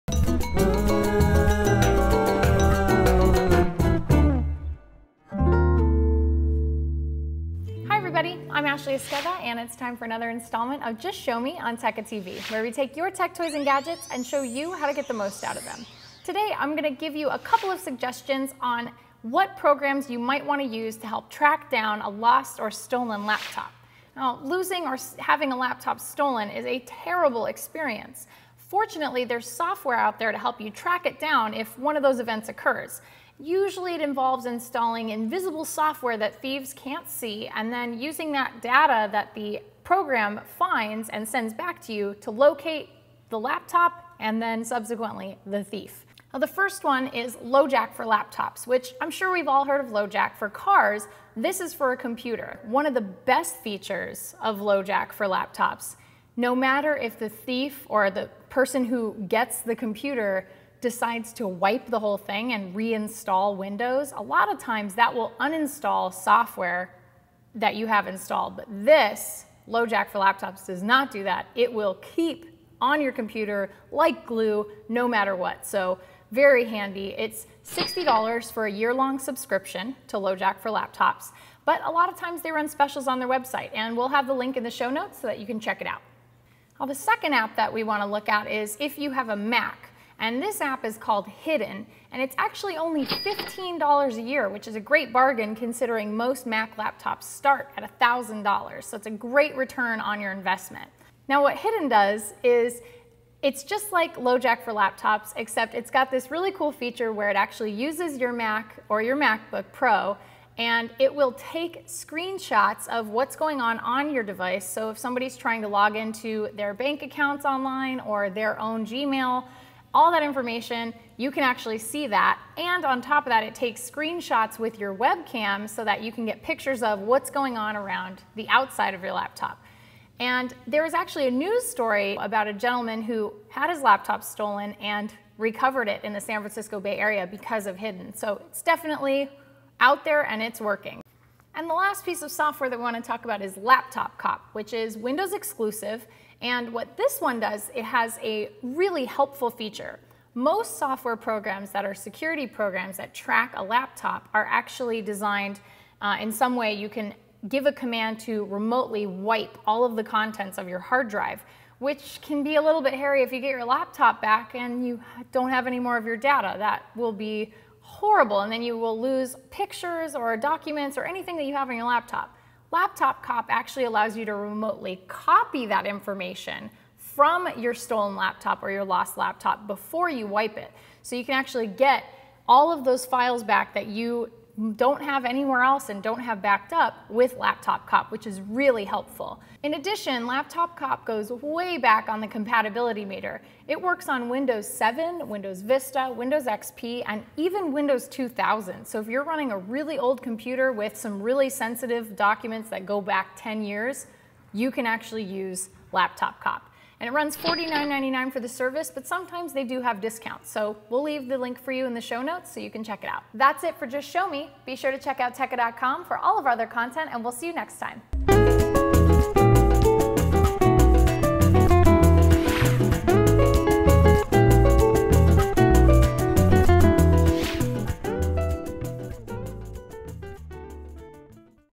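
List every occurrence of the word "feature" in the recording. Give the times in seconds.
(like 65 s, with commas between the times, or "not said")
53 s, 106 s, 149 s.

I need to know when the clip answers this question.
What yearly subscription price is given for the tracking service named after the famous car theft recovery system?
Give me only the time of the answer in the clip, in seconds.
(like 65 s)
77 s.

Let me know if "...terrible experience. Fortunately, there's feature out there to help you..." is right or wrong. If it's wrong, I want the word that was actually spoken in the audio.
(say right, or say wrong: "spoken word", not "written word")
wrong: "software", not "feature".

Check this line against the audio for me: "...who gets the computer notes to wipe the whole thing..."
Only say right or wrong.
wrong.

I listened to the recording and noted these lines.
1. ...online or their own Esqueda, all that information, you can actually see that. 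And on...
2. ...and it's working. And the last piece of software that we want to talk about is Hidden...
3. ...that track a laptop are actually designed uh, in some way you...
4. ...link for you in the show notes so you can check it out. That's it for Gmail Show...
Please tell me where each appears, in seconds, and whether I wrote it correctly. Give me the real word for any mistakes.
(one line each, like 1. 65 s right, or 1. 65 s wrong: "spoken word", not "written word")
1. 117 s wrong: "Gmail", not "Esqueda"
2. 140 s wrong: "Laptop", not "Hidden"
3. 152 s right
4. 211 s wrong: "Just", not "Gmail".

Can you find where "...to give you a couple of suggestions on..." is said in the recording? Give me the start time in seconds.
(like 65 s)
16 s.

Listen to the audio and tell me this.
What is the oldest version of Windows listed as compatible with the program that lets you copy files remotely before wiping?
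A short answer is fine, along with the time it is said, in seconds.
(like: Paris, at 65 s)
Windows 2000, at 197 s.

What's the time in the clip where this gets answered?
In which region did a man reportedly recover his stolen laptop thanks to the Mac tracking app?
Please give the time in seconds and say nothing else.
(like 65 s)
136 s.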